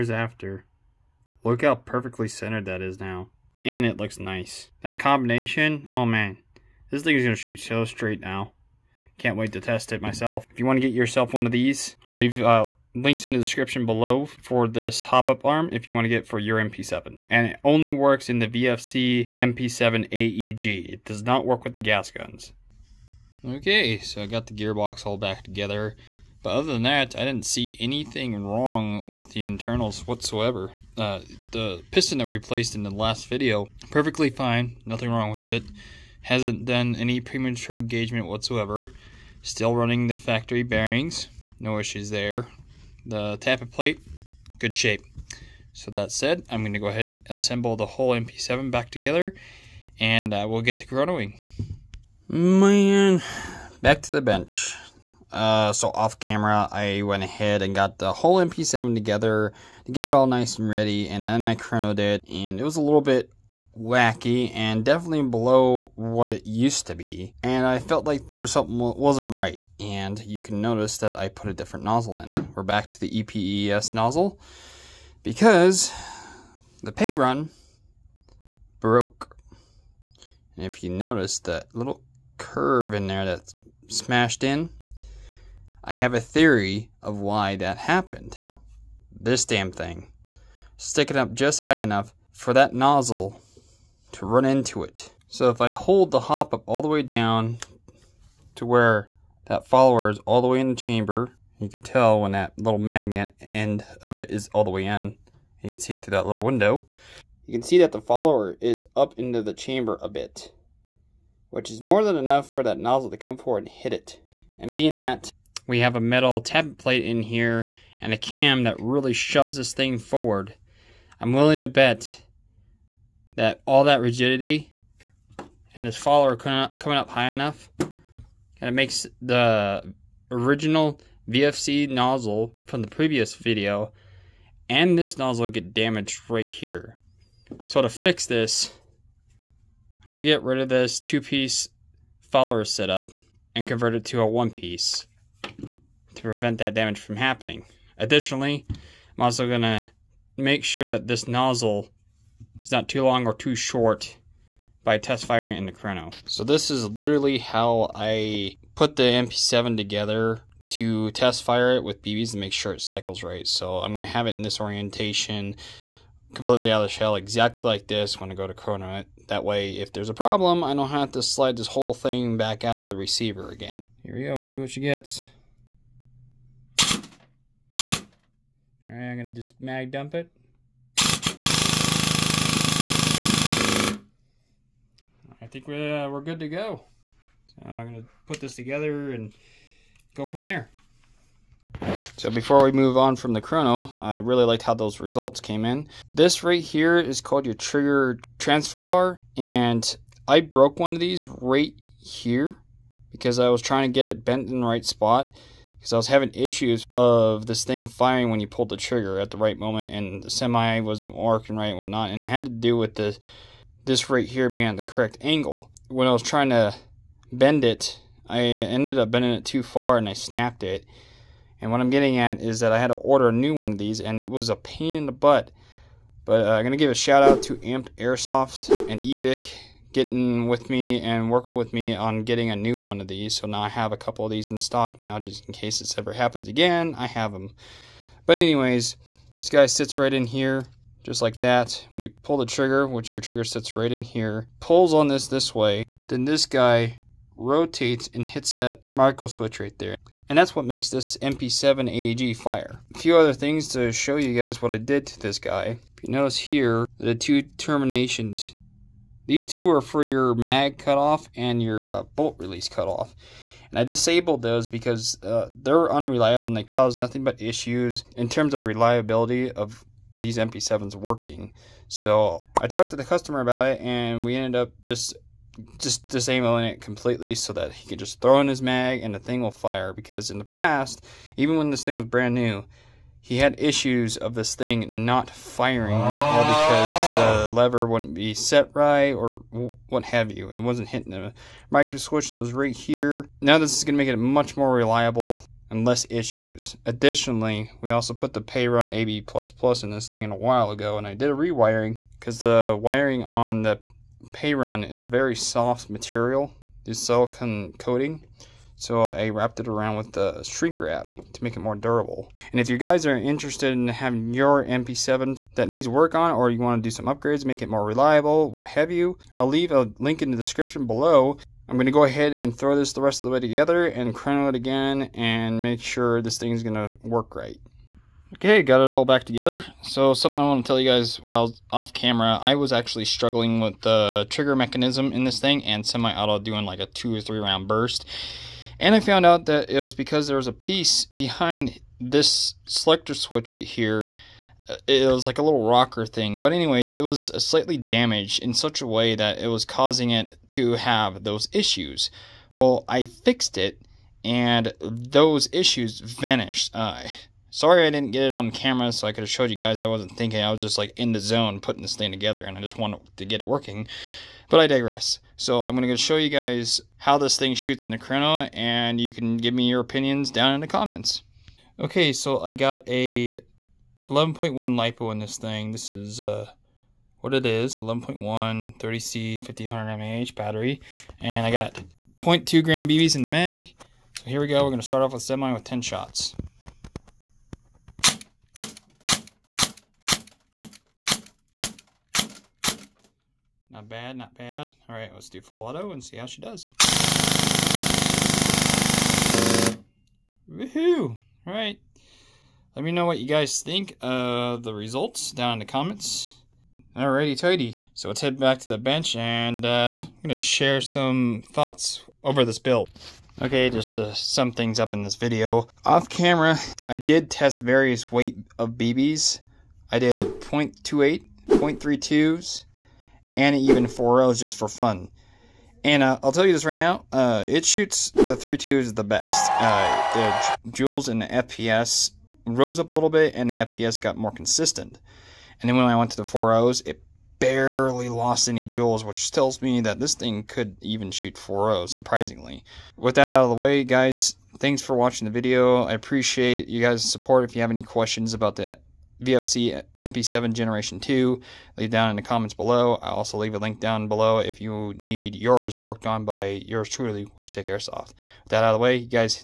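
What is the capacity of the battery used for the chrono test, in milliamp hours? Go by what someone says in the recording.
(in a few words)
500 mAh.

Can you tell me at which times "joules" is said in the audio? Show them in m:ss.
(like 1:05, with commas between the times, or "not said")
7:10, 7:18.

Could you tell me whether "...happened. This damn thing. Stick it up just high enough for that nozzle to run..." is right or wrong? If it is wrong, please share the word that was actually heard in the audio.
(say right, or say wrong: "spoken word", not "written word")
right.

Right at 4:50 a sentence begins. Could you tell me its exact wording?
It wasn't hitting the micro switch that was right here.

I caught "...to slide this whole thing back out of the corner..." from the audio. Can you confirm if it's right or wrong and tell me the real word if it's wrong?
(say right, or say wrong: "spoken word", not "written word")
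wrong: "receiver", not "corner".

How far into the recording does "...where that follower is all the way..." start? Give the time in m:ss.
1:38.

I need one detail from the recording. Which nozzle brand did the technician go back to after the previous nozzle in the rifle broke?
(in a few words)
EPES.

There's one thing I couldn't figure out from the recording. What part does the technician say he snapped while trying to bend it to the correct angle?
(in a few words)
Trigger transfer bar.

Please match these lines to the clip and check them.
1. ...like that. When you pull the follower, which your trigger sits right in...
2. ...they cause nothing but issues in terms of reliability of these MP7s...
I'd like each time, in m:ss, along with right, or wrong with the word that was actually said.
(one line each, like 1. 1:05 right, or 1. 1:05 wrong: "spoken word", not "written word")
1. 4:01 wrong: "trigger", not "follower"
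2. 4:26 right.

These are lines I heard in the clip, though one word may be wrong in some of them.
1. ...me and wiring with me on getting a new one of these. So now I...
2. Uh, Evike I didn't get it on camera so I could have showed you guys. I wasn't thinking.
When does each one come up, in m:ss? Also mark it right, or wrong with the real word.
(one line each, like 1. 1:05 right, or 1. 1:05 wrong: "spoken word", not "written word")
1. 3:50 wrong: "working", not "wiring"
2. 5:56 wrong: "Sorry", not "Evike".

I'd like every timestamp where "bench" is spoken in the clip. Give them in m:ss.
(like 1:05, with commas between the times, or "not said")
0:54, 6:48.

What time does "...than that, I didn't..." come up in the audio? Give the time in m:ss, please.
0:26.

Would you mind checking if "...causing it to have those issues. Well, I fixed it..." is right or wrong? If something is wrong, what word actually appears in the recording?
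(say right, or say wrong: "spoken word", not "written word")
right.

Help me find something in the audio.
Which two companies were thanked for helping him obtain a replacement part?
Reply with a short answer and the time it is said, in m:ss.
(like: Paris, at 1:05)
Amped Airsoft and Evike, at 3:47.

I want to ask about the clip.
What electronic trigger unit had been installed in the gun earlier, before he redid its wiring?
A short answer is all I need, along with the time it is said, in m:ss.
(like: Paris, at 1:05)
Perun AB++, at 4:58.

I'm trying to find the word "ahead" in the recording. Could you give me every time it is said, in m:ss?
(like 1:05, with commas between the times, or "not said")
0:46, 0:57, 5:22.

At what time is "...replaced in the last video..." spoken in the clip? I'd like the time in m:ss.
0:32.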